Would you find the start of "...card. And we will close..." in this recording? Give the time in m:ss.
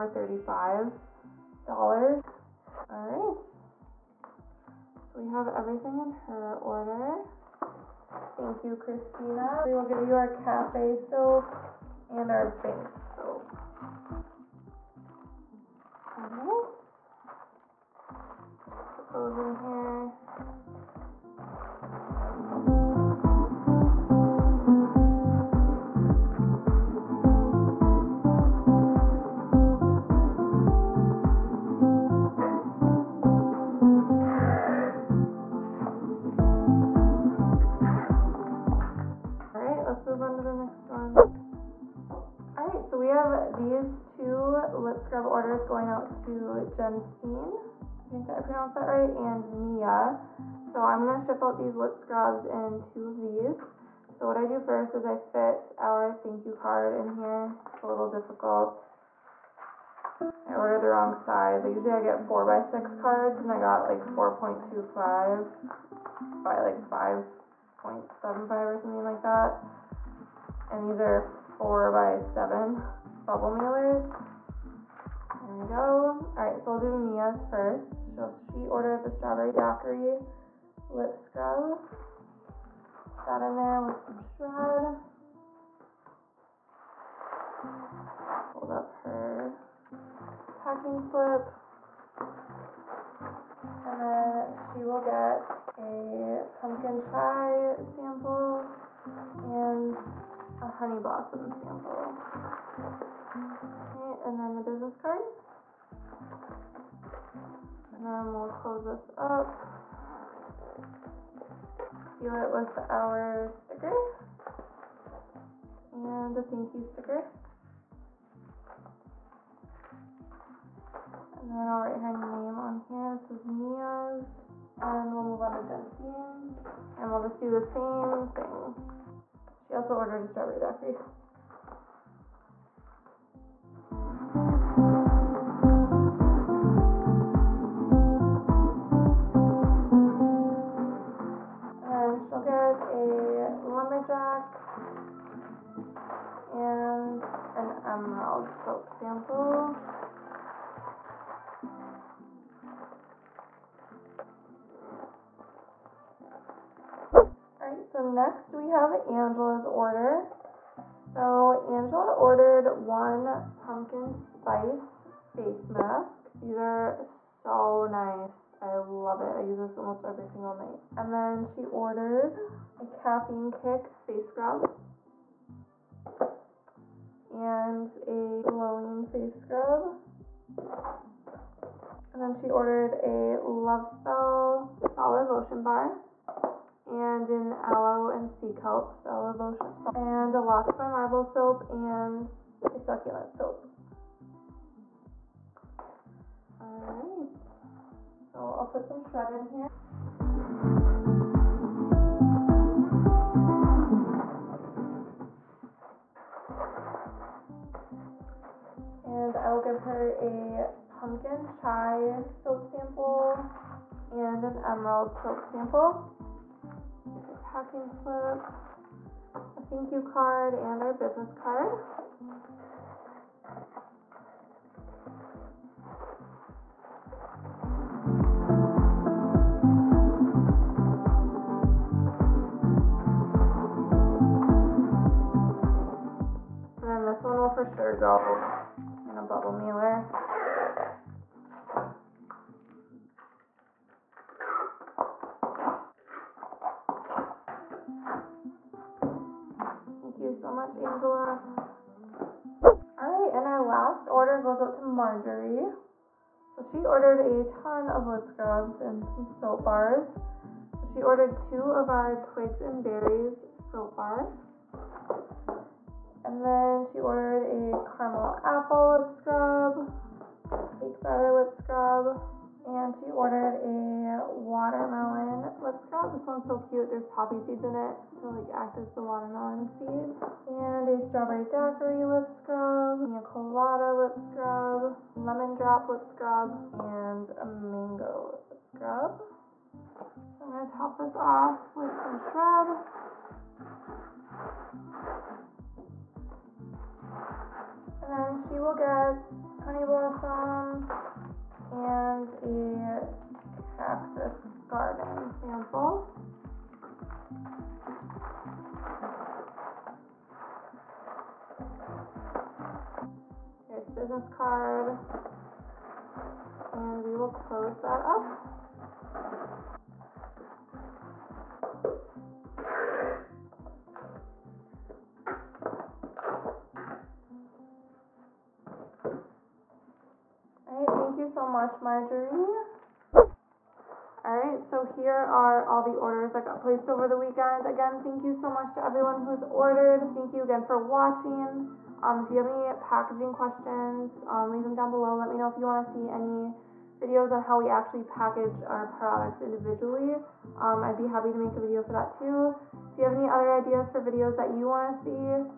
5:14.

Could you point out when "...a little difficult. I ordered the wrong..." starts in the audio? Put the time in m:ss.
0:57.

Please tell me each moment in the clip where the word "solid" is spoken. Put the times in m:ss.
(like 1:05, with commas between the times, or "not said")
3:04, 3:08.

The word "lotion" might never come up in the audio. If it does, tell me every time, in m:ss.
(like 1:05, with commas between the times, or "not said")
3:05, 3:09.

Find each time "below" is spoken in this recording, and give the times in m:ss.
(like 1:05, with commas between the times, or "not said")
5:44.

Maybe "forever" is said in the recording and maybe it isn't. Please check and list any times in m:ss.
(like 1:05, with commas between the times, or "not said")
not said.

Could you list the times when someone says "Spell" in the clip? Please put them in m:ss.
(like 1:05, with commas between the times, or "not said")
3:03.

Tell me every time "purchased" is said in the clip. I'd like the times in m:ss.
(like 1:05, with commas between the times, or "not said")
not said.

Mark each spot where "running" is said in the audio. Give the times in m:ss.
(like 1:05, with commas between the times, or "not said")
not said.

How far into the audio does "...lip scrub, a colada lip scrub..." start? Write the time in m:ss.
4:42.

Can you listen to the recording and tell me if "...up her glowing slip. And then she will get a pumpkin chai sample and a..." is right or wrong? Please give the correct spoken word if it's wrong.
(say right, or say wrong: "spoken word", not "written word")
wrong: "packing", not "glowing".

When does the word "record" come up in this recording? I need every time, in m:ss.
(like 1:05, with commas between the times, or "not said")
not said.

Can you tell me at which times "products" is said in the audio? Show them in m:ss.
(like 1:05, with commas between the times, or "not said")
5:48.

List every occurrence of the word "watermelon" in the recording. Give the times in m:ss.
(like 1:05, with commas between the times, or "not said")
4:34, 4:39.